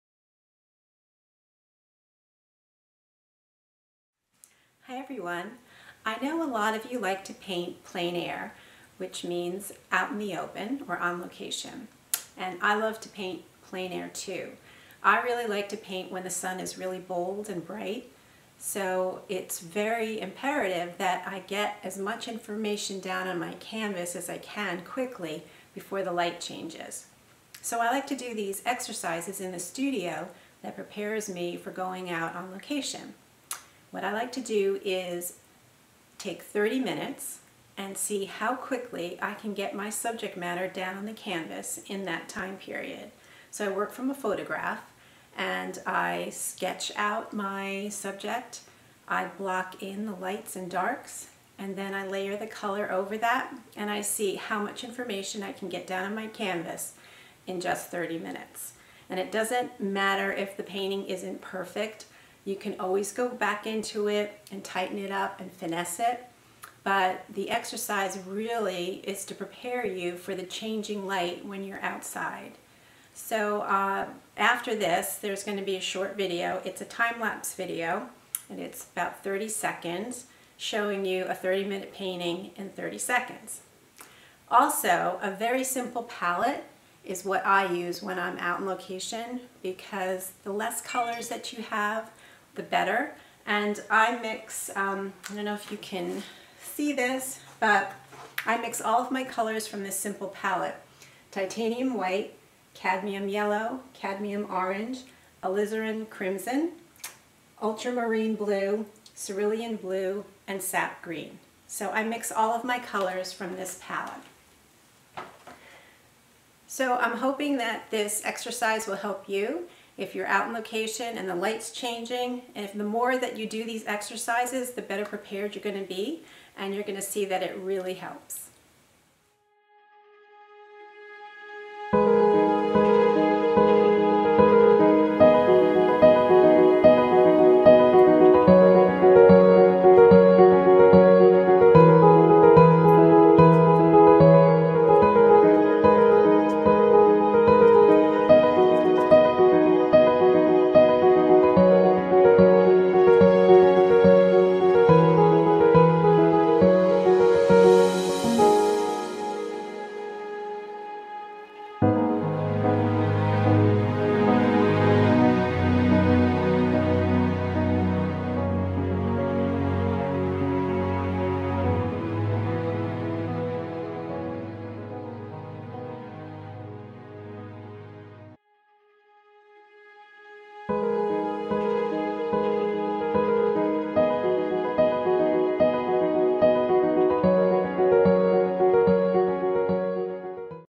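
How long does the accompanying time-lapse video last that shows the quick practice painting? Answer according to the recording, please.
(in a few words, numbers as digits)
30 seconds.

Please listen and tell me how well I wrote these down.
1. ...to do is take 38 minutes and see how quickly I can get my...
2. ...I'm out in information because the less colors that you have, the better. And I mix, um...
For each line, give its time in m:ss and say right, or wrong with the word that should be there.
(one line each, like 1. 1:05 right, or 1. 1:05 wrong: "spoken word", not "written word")
1. 0:34 wrong: "30", not "38"
2. 1:28 wrong: "location", not "information".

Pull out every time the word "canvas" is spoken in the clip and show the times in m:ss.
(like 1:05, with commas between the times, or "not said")
0:23, 0:41, 0:56.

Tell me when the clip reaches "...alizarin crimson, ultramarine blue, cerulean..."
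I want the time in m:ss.
1:45.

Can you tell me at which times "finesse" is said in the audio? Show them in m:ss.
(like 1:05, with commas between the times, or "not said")
1:05.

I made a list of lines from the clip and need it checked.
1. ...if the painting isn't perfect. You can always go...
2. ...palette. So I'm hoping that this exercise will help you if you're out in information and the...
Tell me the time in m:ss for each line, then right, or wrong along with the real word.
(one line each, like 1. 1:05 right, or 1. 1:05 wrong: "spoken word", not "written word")
1. 1:00 right
2. 1:53 wrong: "location", not "information".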